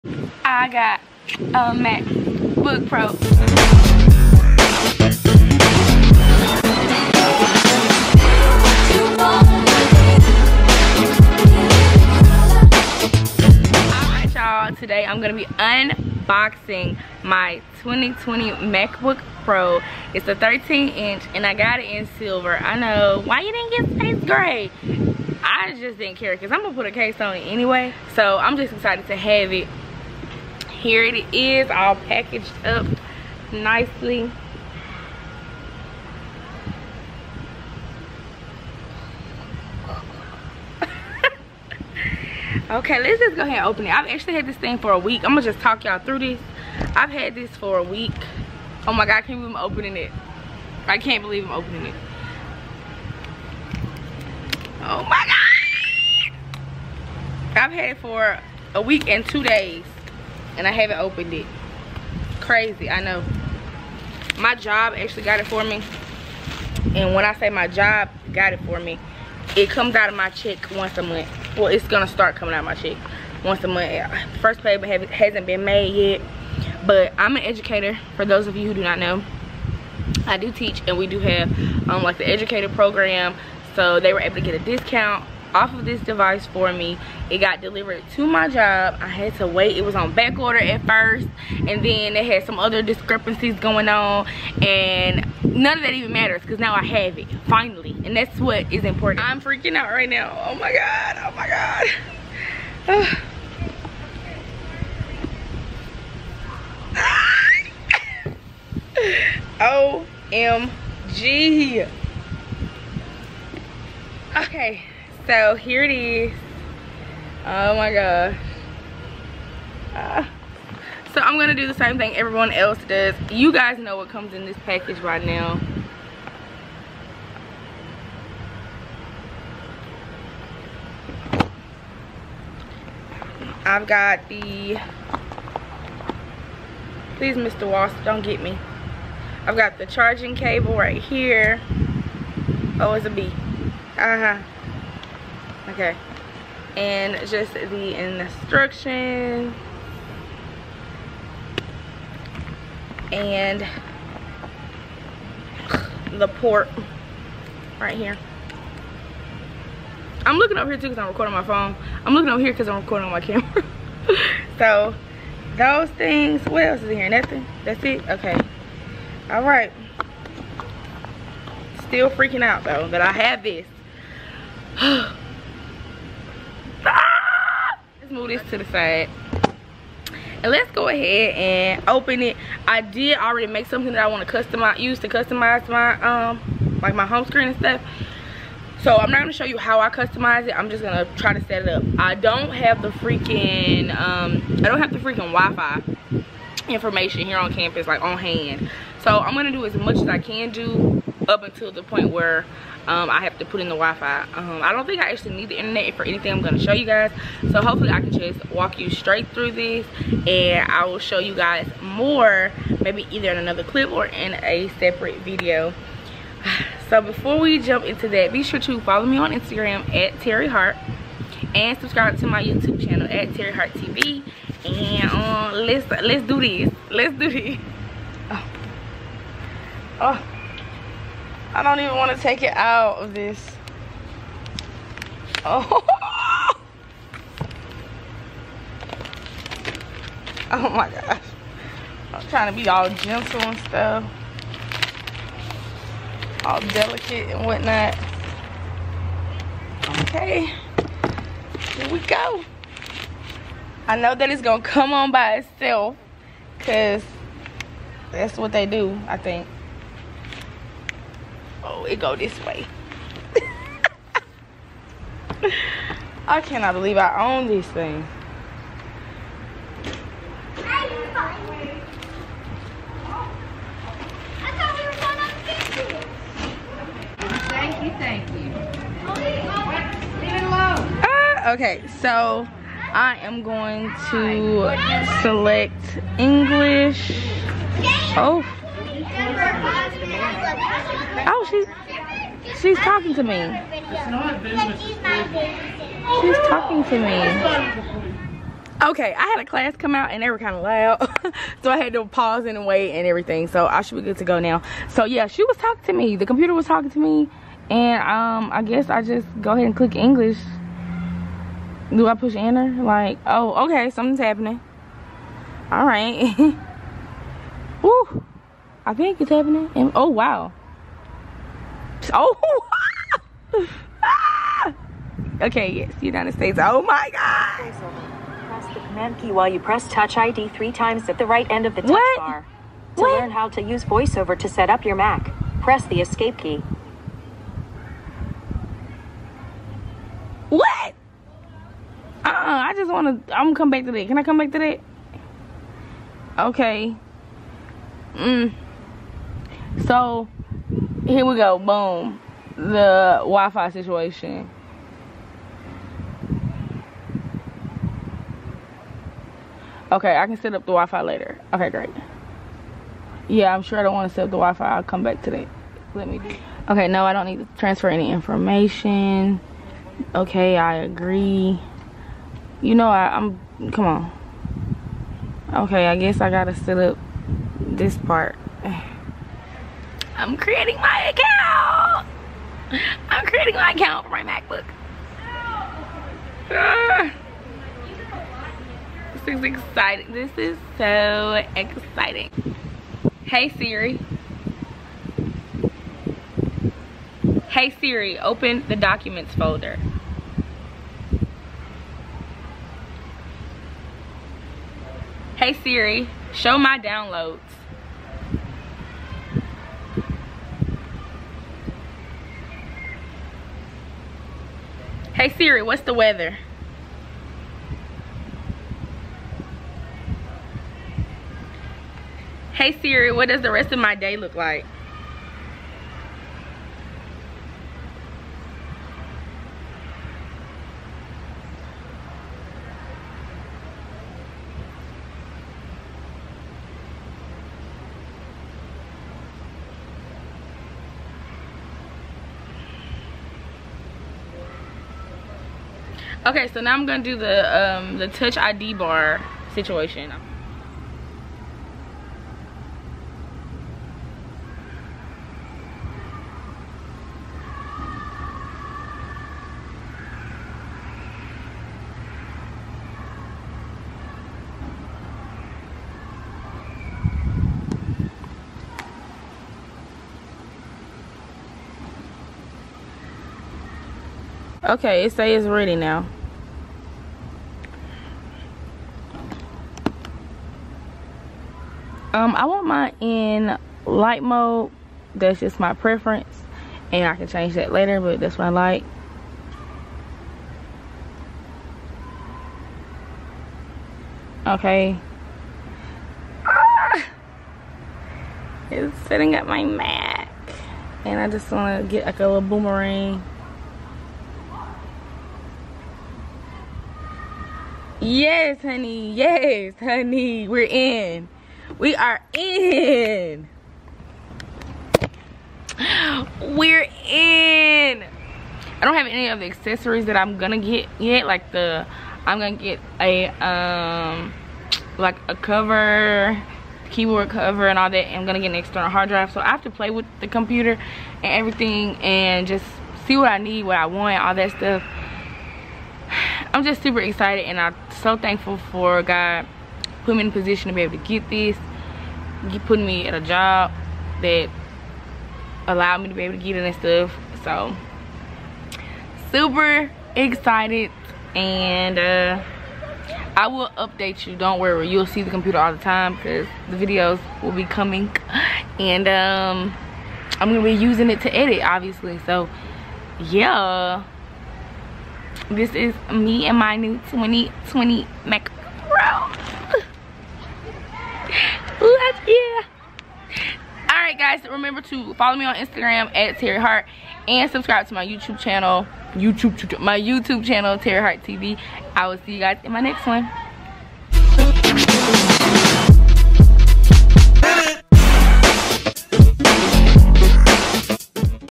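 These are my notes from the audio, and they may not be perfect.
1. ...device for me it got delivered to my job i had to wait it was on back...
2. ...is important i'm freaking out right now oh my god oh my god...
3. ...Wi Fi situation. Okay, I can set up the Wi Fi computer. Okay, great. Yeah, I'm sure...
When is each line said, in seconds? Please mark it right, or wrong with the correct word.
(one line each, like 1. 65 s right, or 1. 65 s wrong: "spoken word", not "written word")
1. 86 s right
2. 98 s right
3. 353 s wrong: "later", not "computer".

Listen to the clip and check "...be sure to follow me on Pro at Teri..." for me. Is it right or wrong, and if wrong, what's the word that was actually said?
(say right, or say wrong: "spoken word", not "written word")
wrong: "Instagram", not "Pro".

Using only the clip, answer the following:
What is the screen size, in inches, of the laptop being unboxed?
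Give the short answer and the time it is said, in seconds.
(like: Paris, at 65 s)
13, at 20 s.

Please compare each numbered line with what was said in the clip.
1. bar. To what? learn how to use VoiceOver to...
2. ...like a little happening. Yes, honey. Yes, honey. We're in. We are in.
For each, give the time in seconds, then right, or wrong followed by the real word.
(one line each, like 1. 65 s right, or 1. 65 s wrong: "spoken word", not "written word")
1. 332 s right
2. 502 s wrong: "boomerang", not "happening".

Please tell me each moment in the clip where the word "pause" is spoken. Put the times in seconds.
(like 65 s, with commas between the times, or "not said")
302 s.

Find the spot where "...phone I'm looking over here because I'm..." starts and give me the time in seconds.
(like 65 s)
161 s.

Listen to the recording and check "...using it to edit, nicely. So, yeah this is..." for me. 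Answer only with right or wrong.
wrong.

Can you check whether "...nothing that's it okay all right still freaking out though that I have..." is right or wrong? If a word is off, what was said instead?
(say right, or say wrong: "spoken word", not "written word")
right.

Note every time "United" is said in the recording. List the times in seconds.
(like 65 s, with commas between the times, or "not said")
326 s.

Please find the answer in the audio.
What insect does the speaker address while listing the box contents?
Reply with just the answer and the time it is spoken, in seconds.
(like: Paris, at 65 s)
Wasp, at 137 s.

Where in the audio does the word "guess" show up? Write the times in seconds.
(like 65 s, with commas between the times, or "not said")
308 s, 375 s.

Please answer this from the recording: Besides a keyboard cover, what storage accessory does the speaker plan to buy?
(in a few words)
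External hard drive.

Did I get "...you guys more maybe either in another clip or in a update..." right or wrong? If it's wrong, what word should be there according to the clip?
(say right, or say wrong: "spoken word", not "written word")
wrong: "separate", not "update".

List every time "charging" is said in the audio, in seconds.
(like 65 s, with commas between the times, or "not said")
139 s.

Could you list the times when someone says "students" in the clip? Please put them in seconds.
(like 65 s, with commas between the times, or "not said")
not said.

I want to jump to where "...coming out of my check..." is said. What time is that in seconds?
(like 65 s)
72 s.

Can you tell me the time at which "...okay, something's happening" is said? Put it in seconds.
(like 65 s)
313 s.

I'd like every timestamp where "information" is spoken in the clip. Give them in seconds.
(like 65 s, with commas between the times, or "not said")
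196 s, 368 s.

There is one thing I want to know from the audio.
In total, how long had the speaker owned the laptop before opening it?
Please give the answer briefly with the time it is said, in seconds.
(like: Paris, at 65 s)
A week and two days, at 58 s.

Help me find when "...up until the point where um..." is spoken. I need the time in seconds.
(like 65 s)
201 s.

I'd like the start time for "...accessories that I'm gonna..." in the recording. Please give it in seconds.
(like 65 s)
519 s.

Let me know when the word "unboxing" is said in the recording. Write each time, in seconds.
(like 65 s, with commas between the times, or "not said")
15 s.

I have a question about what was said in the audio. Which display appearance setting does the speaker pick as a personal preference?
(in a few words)
Light mode.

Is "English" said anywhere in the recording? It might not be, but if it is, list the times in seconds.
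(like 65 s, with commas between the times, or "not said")
286 s, 309 s.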